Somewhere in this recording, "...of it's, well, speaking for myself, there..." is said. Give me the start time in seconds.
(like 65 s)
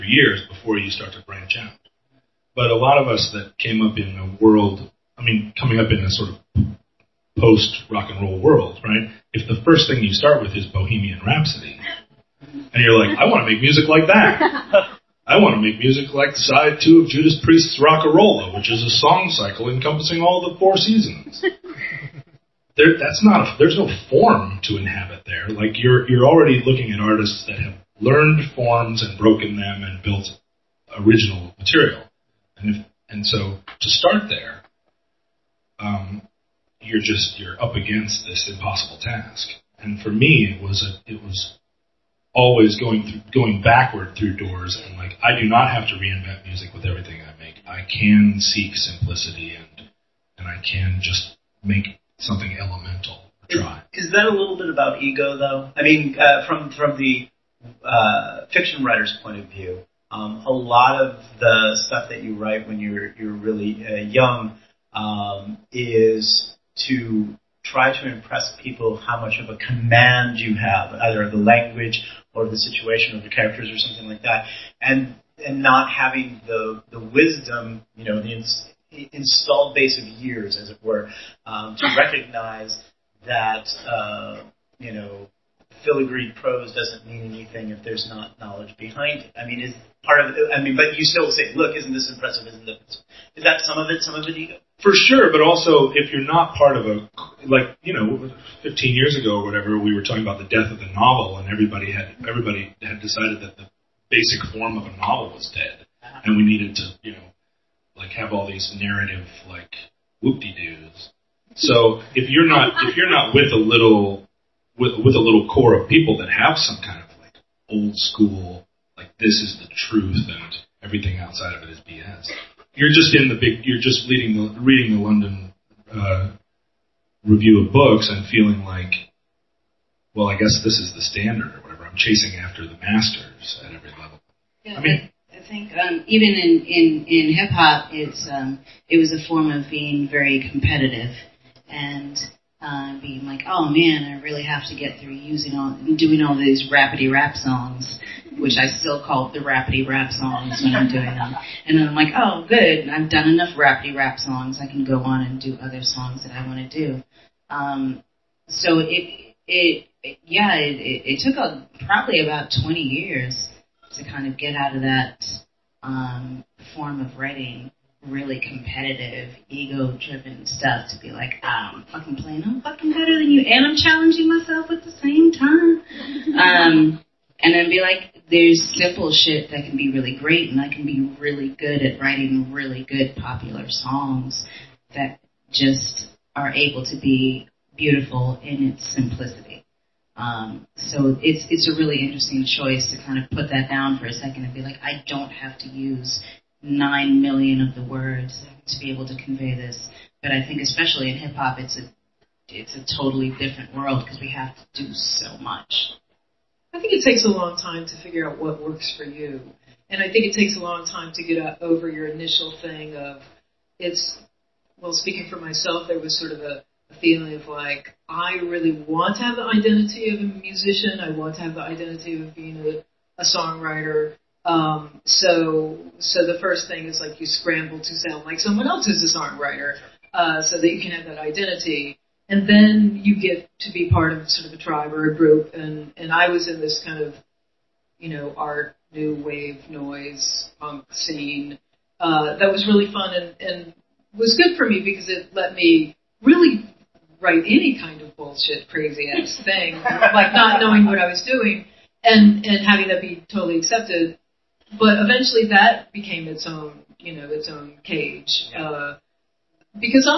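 212 s.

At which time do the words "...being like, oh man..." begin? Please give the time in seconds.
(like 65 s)
143 s.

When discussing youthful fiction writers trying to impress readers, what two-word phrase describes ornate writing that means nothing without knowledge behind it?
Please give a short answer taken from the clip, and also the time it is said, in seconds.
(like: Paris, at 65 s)
filigree prose, at 85 s.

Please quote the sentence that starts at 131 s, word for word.
I'm chasing after the masters at every level.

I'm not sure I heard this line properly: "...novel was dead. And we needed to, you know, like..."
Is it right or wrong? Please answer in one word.
right.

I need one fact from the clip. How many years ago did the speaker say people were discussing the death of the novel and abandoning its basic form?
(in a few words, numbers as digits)
15 years.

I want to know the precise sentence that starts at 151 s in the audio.
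And then I'm like, oh, good, I've done enough rapidy rap songs.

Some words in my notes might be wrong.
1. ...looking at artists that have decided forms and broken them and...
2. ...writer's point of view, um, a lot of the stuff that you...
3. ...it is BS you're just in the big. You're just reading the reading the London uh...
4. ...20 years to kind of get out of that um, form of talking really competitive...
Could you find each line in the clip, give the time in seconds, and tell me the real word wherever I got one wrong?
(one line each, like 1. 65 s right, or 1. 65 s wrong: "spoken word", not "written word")
1. 26 s wrong: "learned", not "decided"
2. 58 s right
3. 121 s right
4. 162 s wrong: "writing", not "talking".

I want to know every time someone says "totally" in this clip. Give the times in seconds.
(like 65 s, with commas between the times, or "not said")
202 s, 253 s.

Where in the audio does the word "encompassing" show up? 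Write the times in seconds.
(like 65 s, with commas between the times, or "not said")
19 s.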